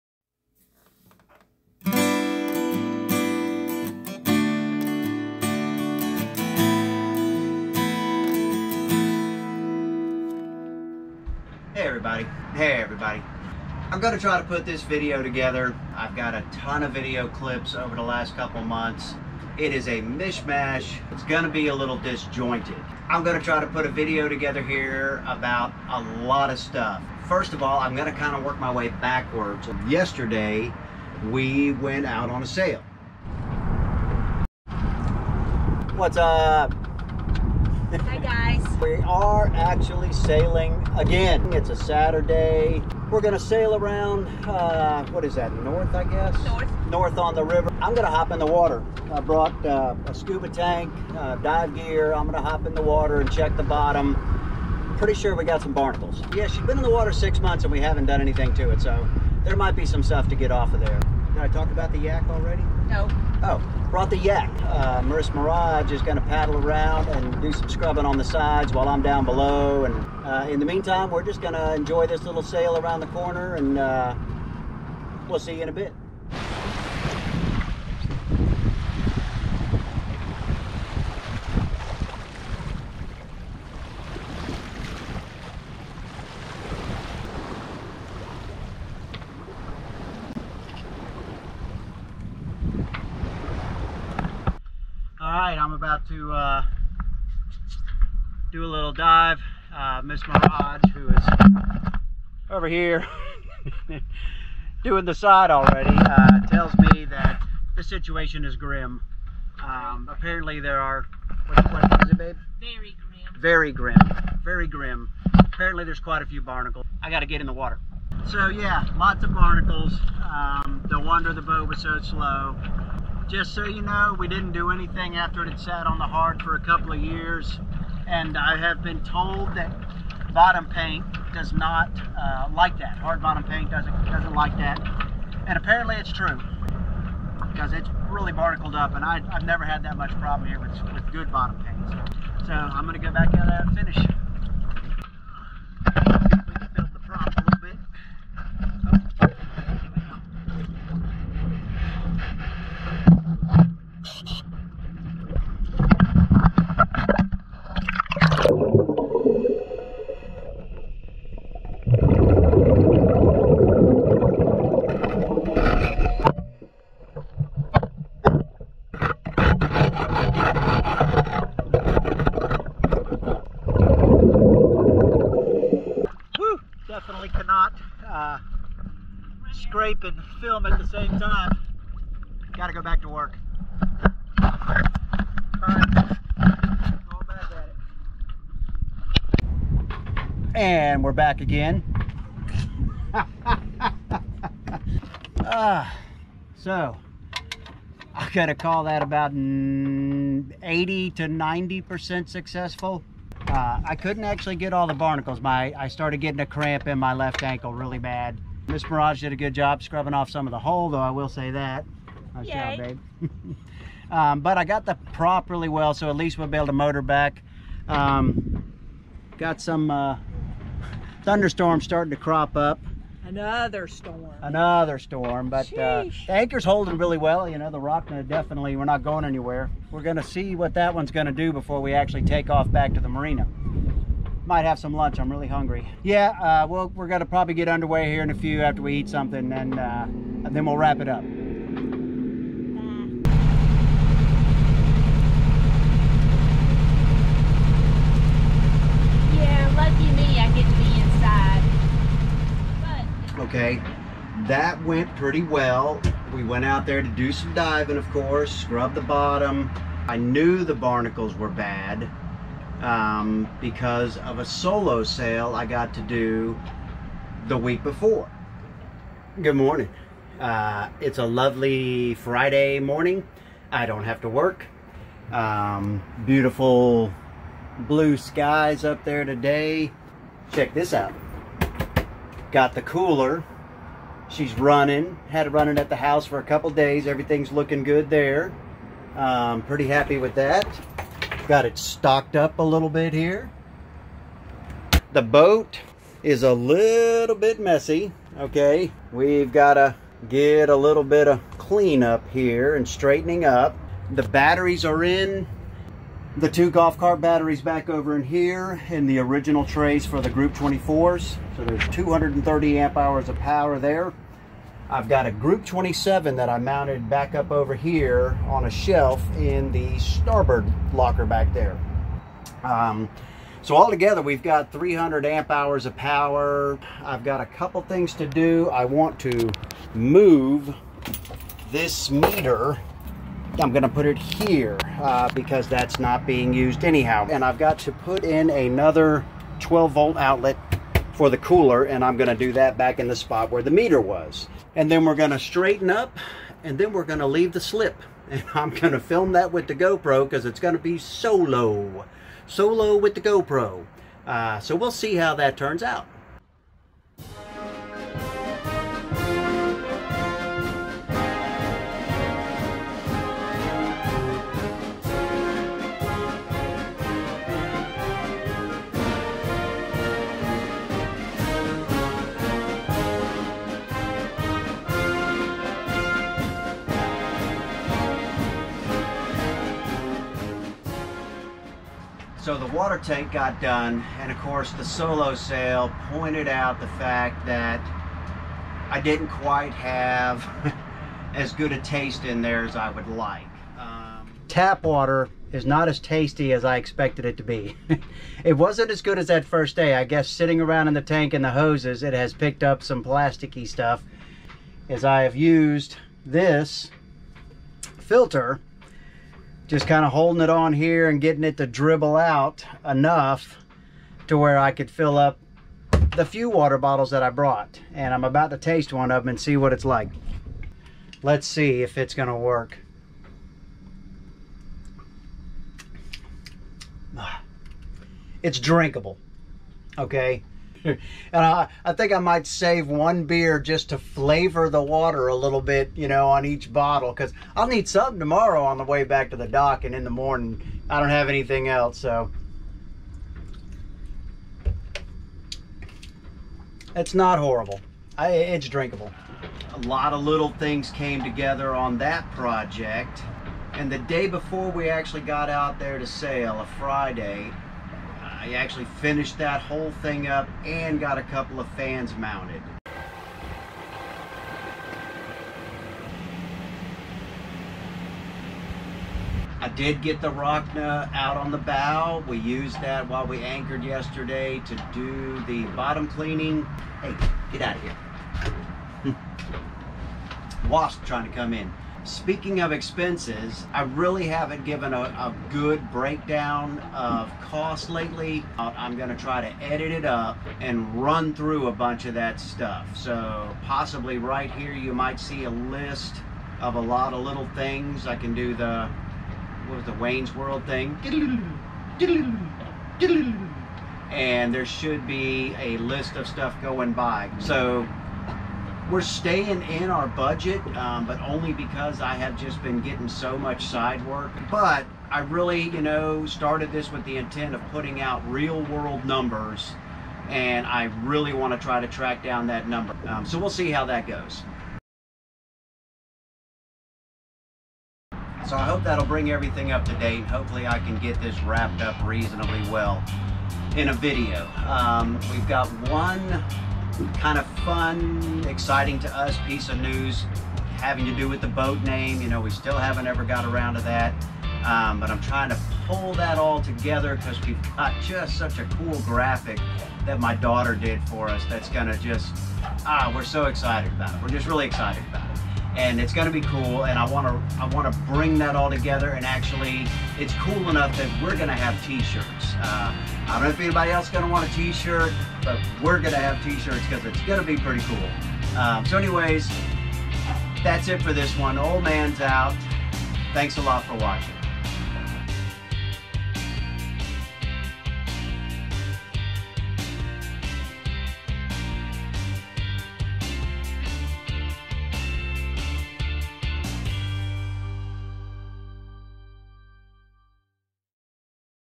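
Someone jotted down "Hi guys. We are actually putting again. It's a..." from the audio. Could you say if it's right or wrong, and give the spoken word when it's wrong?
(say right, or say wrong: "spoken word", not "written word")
wrong: "sailing", not "putting".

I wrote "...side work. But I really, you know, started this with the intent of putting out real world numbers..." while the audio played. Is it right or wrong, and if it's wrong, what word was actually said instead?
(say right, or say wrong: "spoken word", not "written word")
right.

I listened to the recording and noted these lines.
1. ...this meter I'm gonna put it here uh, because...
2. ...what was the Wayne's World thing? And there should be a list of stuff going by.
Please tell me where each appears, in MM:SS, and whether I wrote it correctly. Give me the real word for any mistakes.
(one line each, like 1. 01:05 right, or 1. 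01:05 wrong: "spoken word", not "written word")
1. 05:31 right
2. 08:19 right.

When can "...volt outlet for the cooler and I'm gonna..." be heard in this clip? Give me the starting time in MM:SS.
05:39.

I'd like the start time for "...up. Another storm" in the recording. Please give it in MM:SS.
03:42.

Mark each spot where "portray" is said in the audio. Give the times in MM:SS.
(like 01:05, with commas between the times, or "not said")
not said.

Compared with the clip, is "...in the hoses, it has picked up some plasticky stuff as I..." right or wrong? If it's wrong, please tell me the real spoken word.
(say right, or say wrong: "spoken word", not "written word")
right.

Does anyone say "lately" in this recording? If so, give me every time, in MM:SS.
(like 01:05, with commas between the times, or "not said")
08:07.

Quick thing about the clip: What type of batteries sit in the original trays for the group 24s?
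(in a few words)
Golf cart batteries.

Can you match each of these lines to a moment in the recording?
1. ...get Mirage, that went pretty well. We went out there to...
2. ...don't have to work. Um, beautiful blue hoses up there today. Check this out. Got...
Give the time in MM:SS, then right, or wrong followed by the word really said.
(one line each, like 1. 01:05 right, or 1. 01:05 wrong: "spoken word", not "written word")
1. 04:10 wrong: "Okay", not "Mirage"
2. 04:33 wrong: "skies", not "hoses".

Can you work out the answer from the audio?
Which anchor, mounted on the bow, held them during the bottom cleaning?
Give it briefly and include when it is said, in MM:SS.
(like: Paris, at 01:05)
Rockna, at 07:50.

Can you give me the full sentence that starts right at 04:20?
I knew the barnacles were bad um, because of a solo sail I got to do the week before.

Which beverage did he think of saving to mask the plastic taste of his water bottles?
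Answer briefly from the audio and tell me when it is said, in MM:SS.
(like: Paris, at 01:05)
Beer, at 07:13.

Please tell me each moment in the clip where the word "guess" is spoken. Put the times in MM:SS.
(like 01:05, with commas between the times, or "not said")
00:46, 06:40.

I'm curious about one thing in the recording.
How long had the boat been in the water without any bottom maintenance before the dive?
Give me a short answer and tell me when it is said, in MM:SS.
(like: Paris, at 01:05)
6 months, at 00:57.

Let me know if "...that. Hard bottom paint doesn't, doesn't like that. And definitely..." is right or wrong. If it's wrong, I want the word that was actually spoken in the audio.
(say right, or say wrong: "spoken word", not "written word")
wrong: "apparently", not "definitely".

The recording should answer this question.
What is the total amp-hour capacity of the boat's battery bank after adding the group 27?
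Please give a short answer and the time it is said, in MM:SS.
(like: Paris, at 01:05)
300 amp hours, at 05:24.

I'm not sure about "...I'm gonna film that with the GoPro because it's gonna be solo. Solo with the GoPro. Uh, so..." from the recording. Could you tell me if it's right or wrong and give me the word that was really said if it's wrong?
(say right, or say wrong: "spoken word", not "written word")
right.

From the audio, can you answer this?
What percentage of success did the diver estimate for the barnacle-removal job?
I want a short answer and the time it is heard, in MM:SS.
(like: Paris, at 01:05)
80 to 90%, at 03:19.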